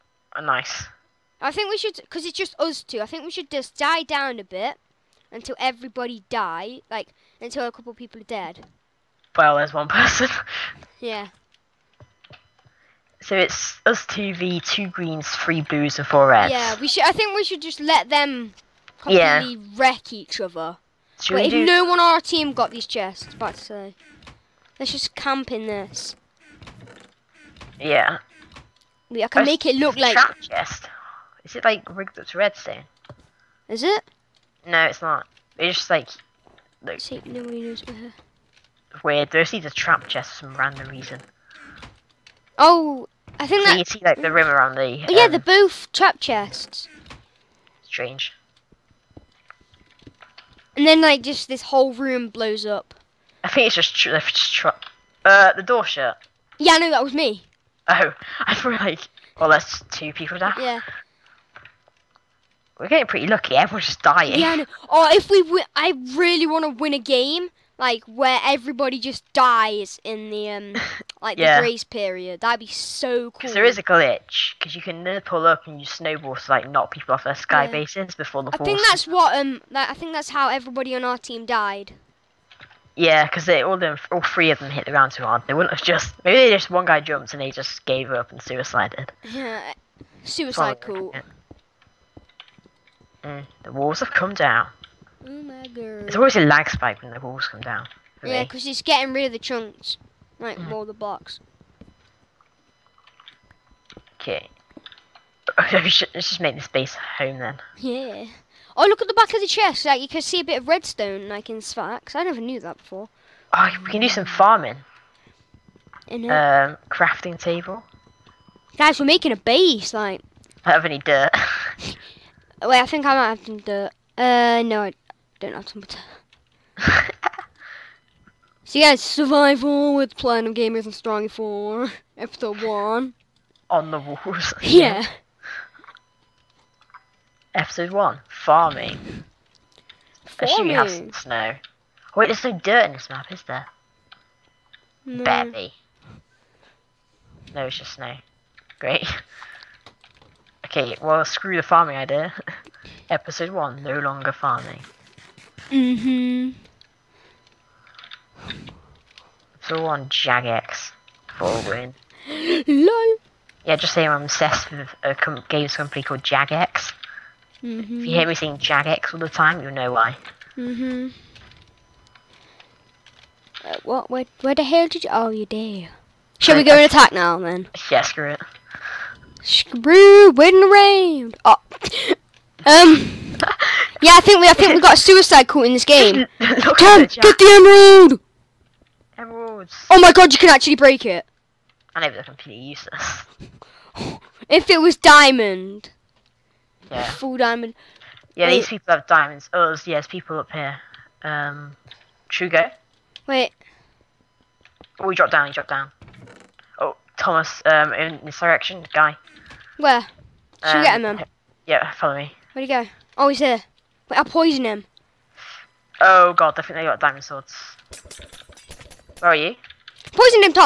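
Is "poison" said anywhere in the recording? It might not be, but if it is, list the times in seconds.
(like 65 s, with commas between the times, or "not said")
214 s, 220 s.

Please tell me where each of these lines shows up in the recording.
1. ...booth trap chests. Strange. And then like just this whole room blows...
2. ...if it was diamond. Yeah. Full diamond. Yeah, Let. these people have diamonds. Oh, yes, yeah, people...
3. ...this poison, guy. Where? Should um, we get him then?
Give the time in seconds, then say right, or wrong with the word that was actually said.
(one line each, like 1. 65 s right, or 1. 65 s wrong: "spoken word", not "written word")
1. 45 s right
2. 194 s wrong: "Wait", not "Let"
3. 208 s wrong: "direction", not "poison".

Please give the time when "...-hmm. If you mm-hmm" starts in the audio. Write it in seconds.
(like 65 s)
167 s.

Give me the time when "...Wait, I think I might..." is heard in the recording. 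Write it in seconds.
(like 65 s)
122 s.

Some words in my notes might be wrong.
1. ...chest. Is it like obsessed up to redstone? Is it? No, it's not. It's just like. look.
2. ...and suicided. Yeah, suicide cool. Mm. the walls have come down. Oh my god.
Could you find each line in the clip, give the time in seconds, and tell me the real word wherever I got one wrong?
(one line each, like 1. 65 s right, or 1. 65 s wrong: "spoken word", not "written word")
1. 30 s wrong: "rigged", not "obsessed"
2. 88 s right.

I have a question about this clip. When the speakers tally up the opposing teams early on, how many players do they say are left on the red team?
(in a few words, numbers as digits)
4.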